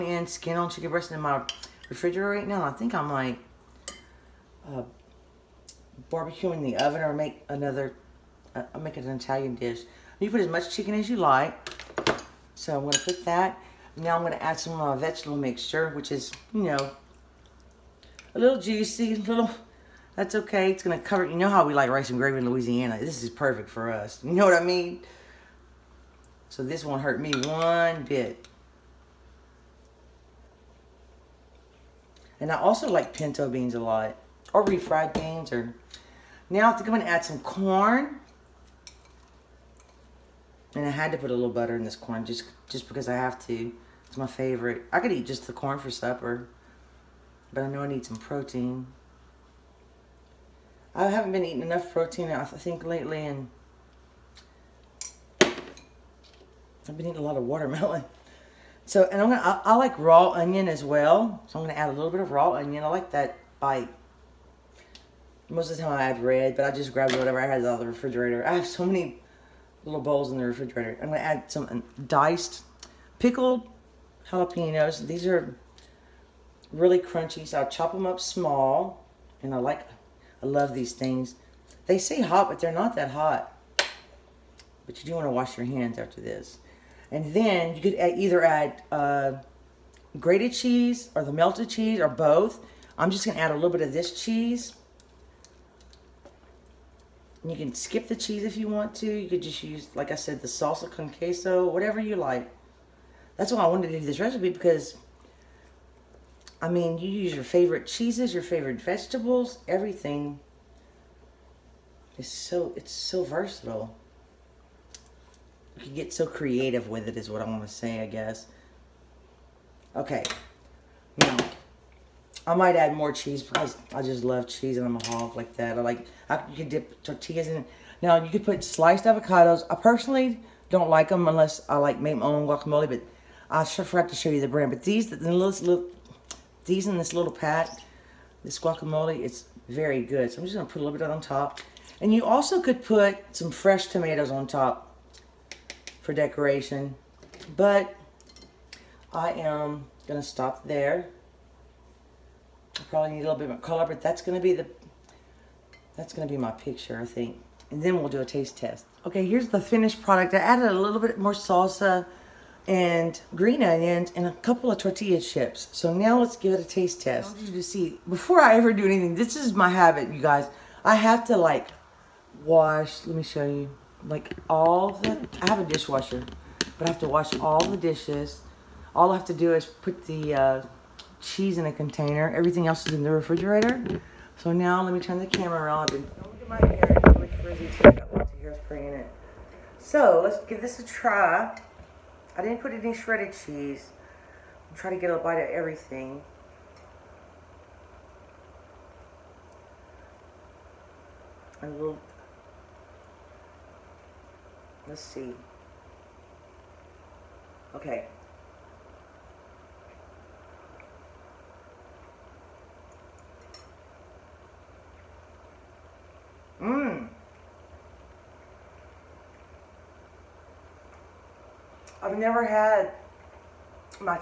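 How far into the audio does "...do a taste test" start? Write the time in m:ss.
2:38.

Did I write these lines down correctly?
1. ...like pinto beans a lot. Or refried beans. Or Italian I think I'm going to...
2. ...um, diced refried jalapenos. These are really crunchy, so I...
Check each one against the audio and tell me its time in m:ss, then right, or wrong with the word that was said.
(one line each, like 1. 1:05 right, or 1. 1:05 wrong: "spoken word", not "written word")
1. 0:32 wrong: "Now", not "Italian"
2. 1:11 wrong: "pickled", not "refried".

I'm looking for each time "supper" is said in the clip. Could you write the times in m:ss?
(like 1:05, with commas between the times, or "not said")
0:45.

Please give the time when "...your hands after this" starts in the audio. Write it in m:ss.
1:25.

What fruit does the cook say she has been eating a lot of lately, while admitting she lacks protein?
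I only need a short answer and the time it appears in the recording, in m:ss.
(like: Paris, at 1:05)
Watermelon, at 0:57.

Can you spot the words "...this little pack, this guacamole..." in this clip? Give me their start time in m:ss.
2:16.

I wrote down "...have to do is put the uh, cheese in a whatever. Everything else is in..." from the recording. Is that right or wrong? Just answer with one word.
wrong.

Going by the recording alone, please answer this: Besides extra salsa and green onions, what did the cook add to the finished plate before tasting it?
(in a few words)
Tortilla chips.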